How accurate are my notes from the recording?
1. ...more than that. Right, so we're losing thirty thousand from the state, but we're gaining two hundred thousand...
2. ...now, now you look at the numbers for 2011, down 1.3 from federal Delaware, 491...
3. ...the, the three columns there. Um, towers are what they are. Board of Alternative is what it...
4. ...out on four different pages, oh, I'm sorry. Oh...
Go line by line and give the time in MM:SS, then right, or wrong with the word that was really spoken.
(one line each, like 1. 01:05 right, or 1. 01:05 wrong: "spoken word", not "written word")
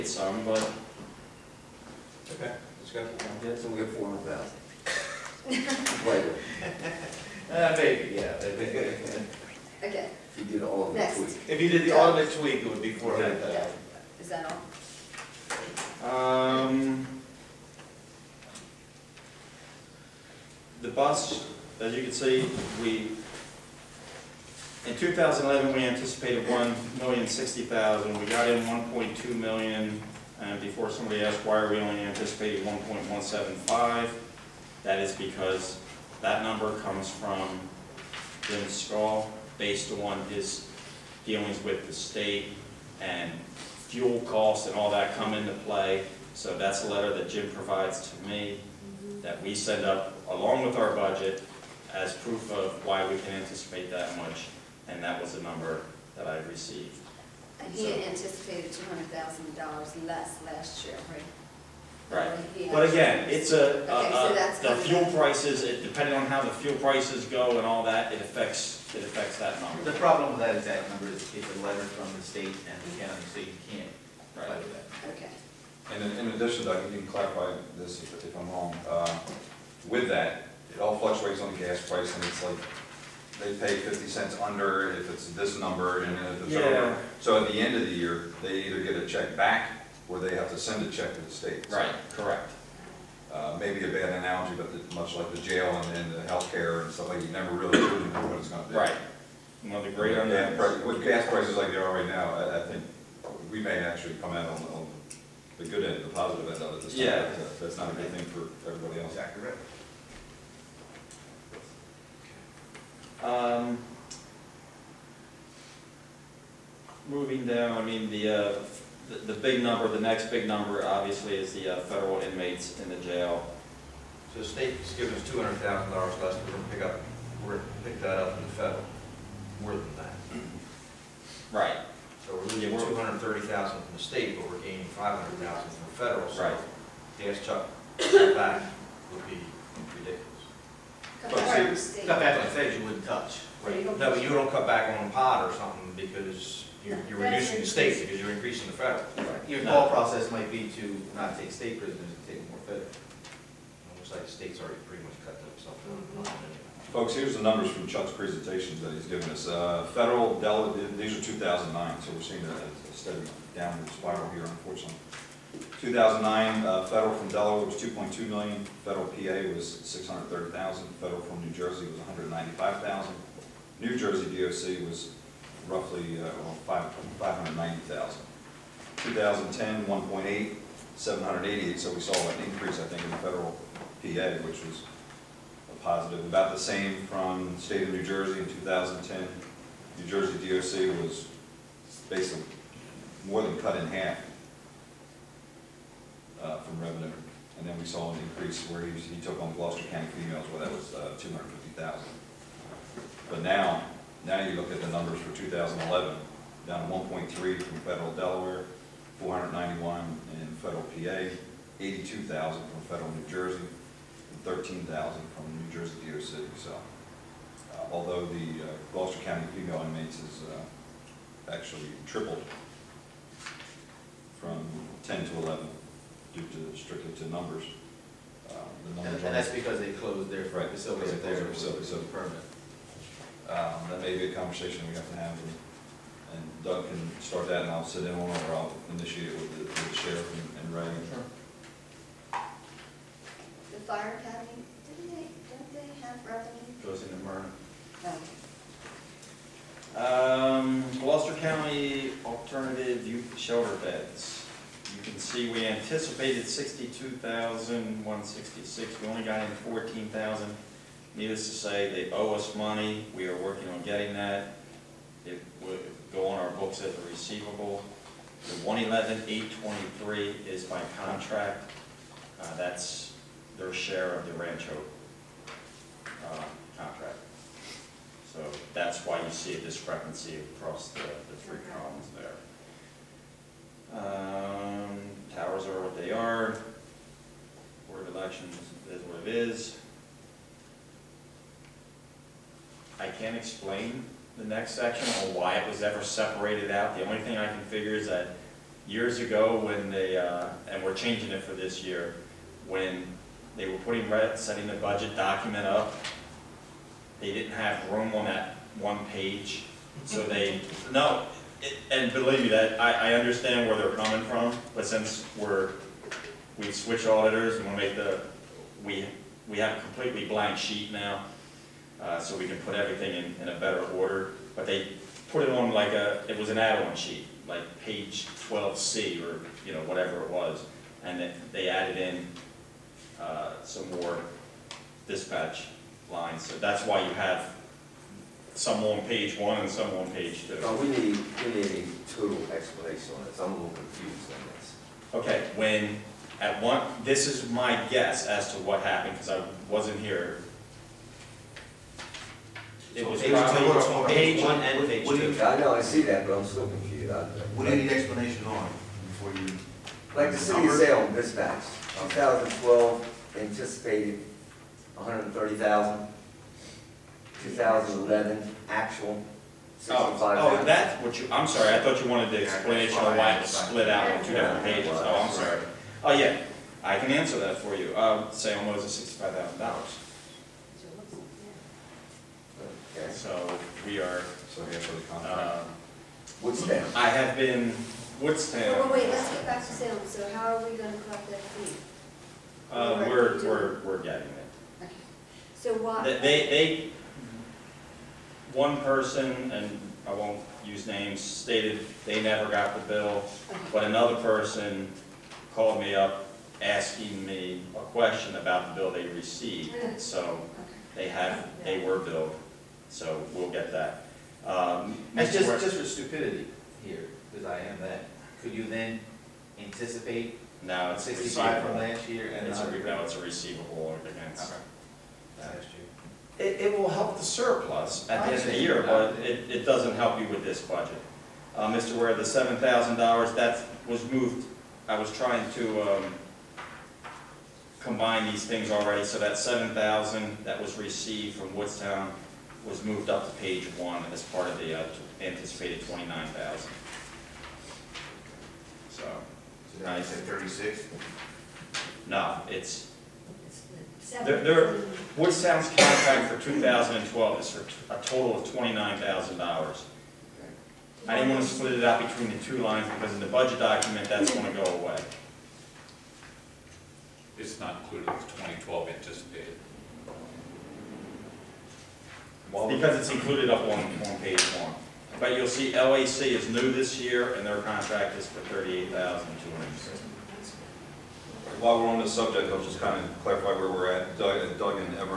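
1. 02:09 wrong: "five", not "two"
2. 03:23 right
3. 04:40 wrong: "Elections", not "Alternative"
4. 06:13 wrong: "two", not "four".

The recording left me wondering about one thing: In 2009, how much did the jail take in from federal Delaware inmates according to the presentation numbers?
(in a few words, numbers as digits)
2.2 million.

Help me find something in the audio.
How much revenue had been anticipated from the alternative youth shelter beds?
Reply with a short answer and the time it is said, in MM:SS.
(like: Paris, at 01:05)
62,166, at 04:16.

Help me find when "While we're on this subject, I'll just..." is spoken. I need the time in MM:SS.
08:01.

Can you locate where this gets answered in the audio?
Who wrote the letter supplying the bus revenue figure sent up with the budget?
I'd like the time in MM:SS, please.
00:38.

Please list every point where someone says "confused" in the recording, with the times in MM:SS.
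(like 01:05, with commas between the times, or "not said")
05:43, 05:56.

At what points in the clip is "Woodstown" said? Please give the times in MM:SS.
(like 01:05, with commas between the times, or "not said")
07:21, 07:35.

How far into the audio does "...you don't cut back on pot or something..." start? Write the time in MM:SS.
02:24.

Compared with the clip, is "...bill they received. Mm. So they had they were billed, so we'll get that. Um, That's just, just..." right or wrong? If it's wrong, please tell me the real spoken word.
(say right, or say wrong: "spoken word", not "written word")
right.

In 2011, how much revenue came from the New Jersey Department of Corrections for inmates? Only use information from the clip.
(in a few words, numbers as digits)
13,000.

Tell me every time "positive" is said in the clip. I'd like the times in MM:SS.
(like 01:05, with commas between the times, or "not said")
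01:46, 03:05.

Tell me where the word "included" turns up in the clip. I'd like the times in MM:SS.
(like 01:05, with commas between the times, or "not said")
07:47, 07:53.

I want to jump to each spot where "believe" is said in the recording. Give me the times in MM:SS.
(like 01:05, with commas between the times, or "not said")
05:12.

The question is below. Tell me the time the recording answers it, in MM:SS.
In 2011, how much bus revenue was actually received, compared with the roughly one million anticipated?
00:28.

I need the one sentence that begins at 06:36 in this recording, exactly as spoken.
They, they, they, one person, and I won't use names, stated they never got the bill, okay.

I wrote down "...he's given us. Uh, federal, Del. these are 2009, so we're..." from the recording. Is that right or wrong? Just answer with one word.
right.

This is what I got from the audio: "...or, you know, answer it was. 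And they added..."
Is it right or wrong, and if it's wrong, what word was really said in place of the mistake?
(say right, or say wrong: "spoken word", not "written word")
wrong: "whatever", not "answer".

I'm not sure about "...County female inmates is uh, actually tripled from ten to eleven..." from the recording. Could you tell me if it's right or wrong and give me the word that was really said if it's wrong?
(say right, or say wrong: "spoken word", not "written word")
right.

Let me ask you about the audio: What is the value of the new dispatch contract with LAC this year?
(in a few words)
$38,200.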